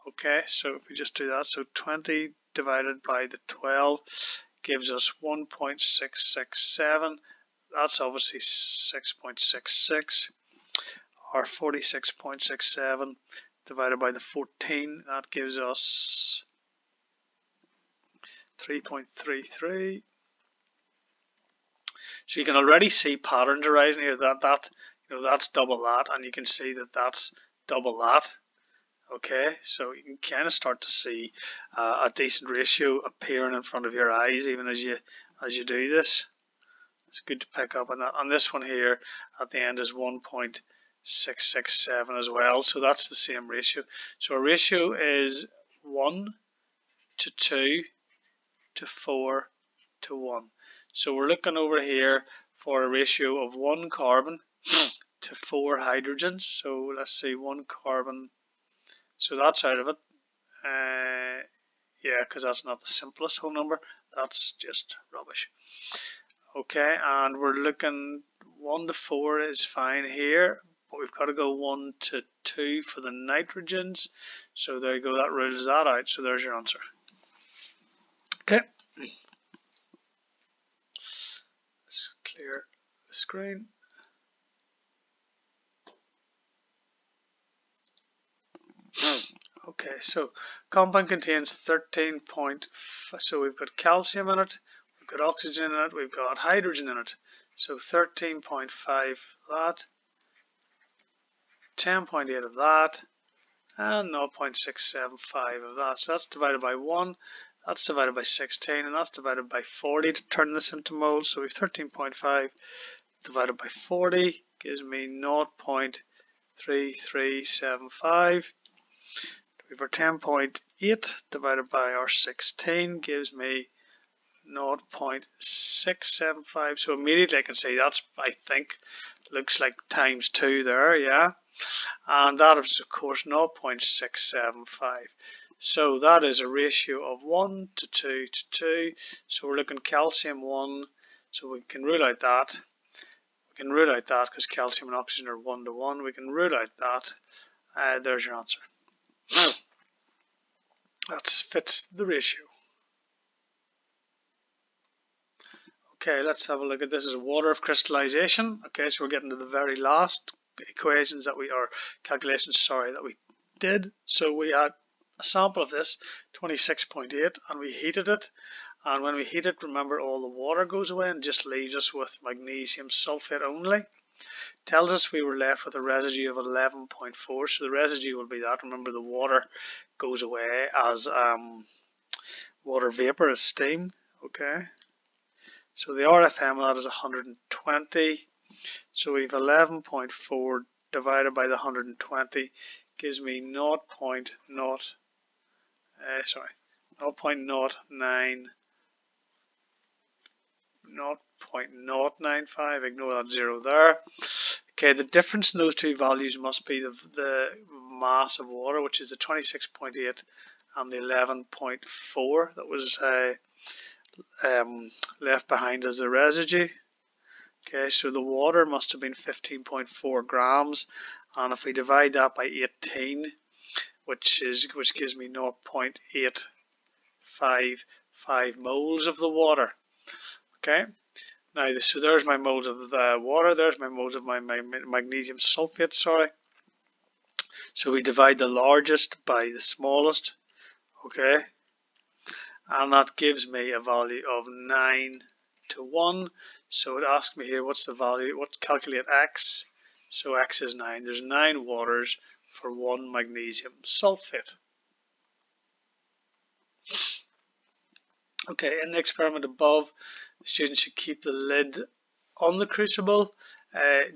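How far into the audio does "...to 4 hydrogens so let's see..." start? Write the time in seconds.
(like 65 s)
55 s.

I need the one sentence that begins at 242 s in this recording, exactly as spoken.
And that gives me a value of 9 to 1.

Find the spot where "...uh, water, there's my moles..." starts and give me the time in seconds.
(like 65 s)
233 s.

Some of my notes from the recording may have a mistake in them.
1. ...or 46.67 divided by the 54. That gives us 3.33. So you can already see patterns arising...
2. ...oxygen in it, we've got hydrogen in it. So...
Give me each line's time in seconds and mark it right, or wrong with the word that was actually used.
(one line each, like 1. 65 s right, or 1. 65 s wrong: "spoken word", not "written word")
1. 11 s wrong: "14", not "54"
2. 95 s right.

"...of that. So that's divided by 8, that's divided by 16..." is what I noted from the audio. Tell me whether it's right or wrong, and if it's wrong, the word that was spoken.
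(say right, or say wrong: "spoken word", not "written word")
wrong: "1", not "8".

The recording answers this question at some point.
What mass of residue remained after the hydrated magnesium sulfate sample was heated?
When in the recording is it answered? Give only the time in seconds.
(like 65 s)
175 s.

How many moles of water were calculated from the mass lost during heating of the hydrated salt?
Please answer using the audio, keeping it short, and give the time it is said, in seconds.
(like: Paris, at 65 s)
0.855, at 225 s.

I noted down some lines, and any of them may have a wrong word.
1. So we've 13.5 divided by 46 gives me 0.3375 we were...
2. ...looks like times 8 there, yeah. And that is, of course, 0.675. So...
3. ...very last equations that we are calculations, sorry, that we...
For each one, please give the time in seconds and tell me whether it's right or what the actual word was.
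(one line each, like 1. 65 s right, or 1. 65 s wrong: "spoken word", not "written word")
1. 111 s wrong: "40", not "46"
2. 129 s wrong: "2", not "8"
3. 159 s right.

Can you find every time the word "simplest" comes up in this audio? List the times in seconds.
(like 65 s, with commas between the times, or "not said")
62 s.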